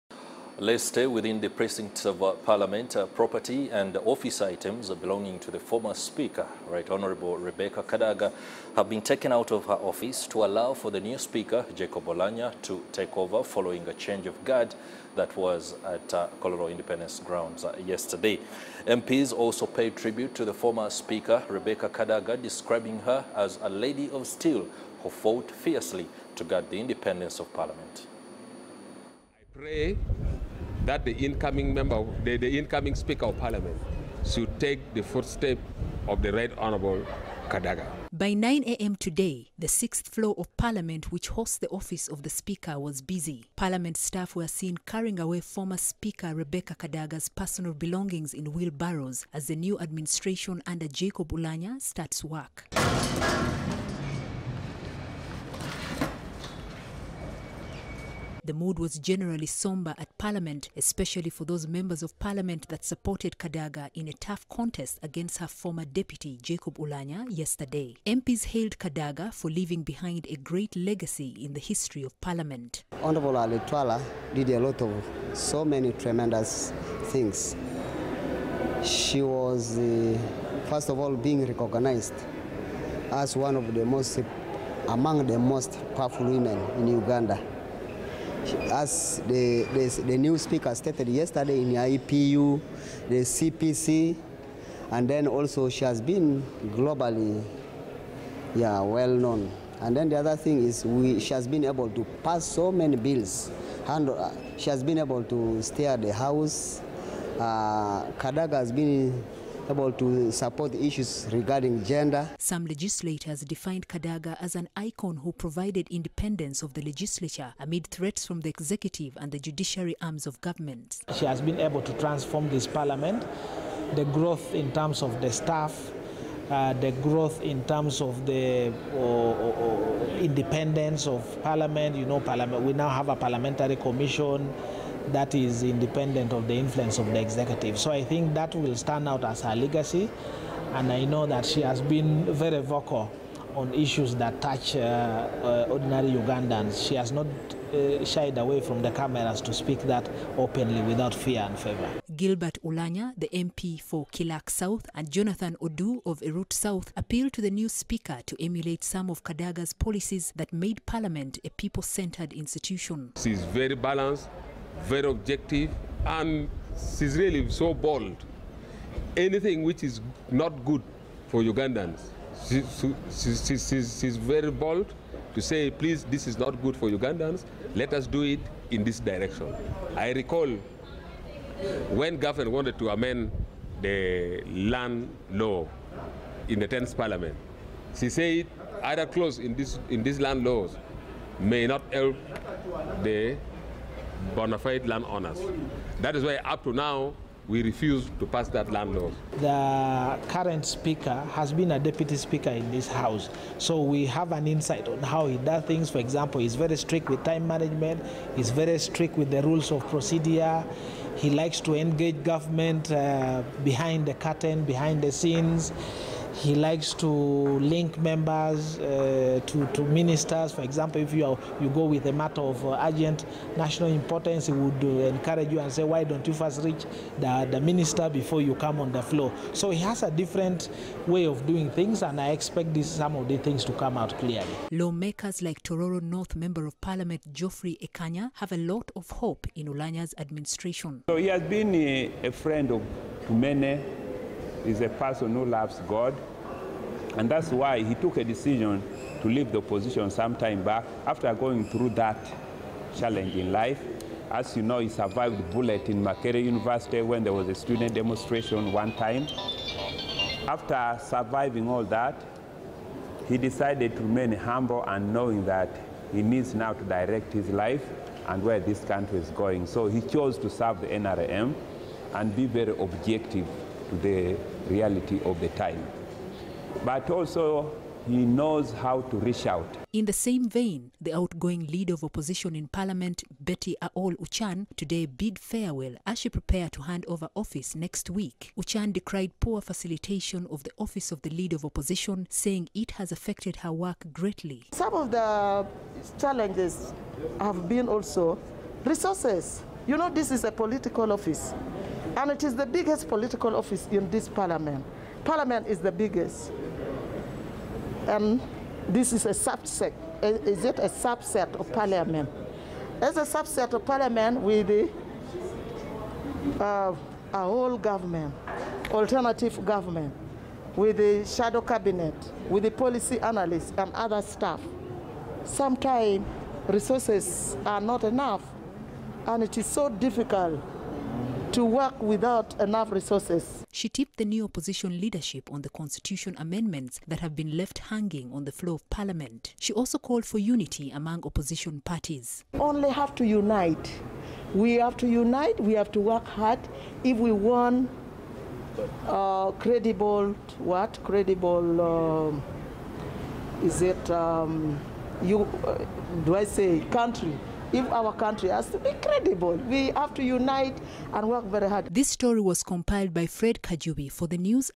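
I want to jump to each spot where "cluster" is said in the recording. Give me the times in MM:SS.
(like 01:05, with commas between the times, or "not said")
not said.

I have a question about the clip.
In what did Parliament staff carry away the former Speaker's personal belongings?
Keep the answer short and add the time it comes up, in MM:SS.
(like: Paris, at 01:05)
Wheelbarrows, at 00:48.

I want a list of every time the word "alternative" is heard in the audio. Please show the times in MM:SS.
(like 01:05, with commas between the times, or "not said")
05:18.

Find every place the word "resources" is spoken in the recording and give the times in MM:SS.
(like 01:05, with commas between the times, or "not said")
04:58, 05:26, 05:32.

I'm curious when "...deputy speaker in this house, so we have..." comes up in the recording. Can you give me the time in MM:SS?
03:21.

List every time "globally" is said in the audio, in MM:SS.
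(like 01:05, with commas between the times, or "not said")
01:36.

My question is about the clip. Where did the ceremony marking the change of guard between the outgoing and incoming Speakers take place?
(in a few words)
Kololo Independence Grounds.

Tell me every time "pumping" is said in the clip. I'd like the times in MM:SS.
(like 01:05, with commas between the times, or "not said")
not said.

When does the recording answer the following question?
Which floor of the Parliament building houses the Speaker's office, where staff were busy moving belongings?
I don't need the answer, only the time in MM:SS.
00:39.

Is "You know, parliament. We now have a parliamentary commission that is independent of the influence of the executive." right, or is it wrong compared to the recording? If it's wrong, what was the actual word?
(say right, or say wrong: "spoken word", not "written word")
right.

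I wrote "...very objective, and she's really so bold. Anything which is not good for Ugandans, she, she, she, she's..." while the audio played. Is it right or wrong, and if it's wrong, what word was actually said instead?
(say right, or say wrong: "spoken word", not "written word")
right.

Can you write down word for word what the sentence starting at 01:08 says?
MPs hailed Kadaga for leaving behind a great legacy in the history of Parliament.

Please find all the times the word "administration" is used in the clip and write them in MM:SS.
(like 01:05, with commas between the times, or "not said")
00:49, 04:00.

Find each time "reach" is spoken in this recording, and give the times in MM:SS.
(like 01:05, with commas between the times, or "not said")
03:46, 04:39.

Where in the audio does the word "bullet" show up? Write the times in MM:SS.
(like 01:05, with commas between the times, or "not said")
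04:15.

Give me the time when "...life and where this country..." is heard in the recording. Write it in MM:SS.
04:27.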